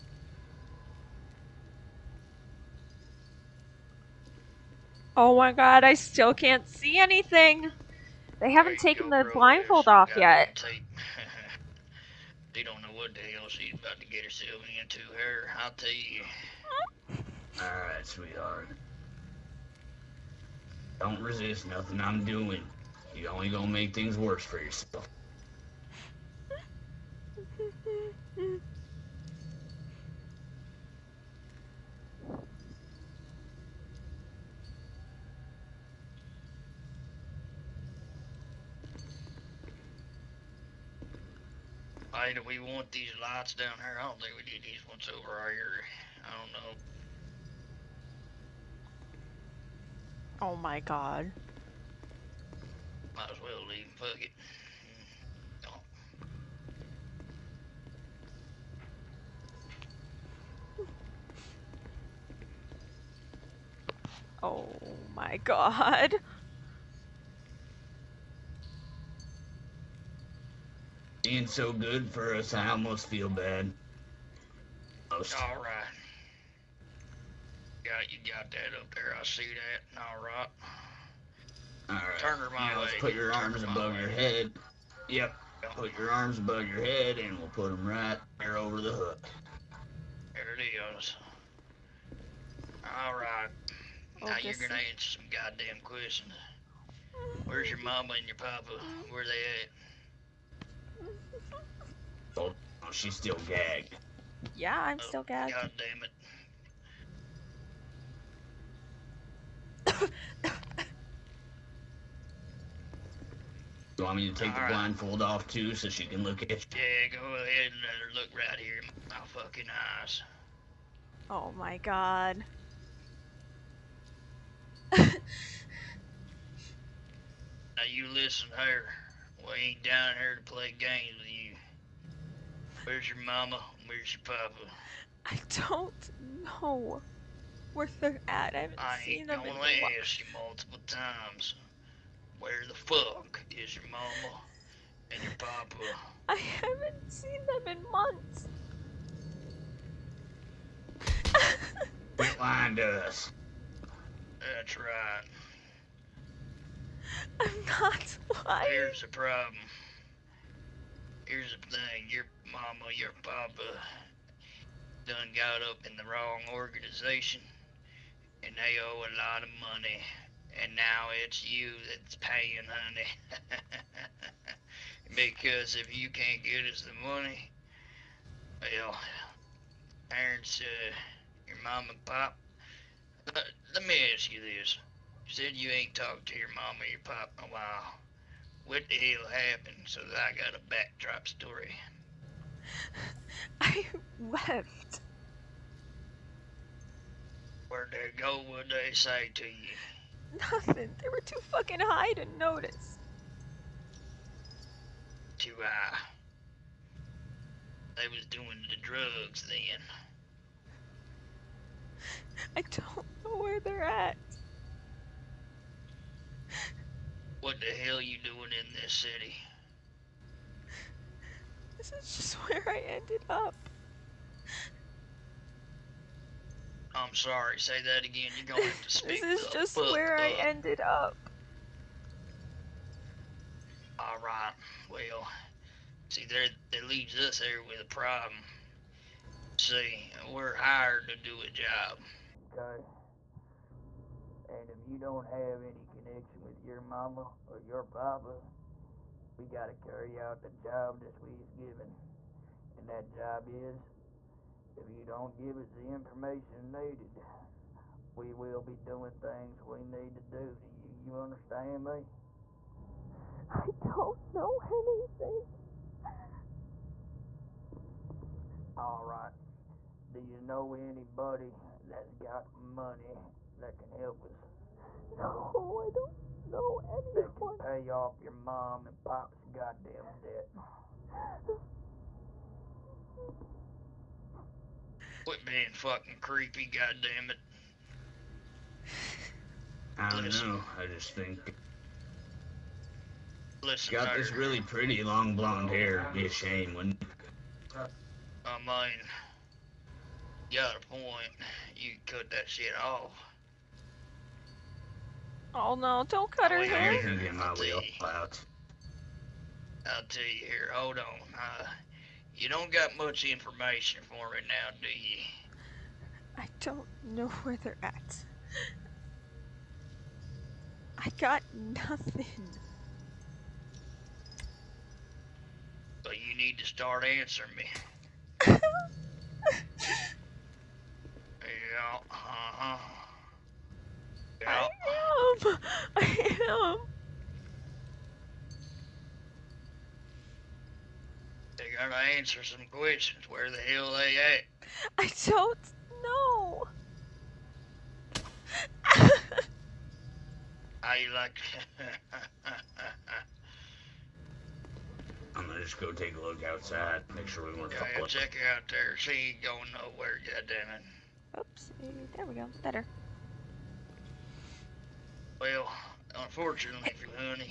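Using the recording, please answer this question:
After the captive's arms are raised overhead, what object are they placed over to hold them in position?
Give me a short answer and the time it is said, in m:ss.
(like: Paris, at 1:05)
the hook, at 1:28.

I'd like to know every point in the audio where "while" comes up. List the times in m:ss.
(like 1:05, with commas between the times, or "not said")
2:19, 3:07.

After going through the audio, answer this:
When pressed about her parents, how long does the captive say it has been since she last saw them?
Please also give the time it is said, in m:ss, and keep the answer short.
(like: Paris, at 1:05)
months, at 2:27.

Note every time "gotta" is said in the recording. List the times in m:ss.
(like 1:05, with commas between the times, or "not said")
4:09, 5:41.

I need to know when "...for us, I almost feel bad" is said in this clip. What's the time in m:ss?
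1:12.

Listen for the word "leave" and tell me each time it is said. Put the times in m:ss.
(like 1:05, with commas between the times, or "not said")
0:53, 3:56.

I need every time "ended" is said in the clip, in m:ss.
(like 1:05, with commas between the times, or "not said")
3:42, 3:50.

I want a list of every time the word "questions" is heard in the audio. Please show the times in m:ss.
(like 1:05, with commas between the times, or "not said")
1:35, 5:42.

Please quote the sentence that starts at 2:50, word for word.
And now it's you that's paying, honey.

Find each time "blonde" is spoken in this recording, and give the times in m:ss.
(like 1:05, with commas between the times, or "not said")
4:55.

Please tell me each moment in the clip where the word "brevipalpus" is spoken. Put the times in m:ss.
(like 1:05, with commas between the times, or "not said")
not said.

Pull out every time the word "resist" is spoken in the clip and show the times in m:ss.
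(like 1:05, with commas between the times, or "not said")
0:21.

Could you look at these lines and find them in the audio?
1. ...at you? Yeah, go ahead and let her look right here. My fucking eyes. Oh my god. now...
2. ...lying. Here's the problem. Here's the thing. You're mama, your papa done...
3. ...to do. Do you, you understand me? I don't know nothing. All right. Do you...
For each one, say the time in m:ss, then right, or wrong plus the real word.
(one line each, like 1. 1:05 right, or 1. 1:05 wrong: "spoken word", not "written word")
1. 1:56 right
2. 2:38 right
3. 4:20 wrong: "anything", not "nothing".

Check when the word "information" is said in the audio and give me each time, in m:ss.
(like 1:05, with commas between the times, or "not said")
4:15, 5:13.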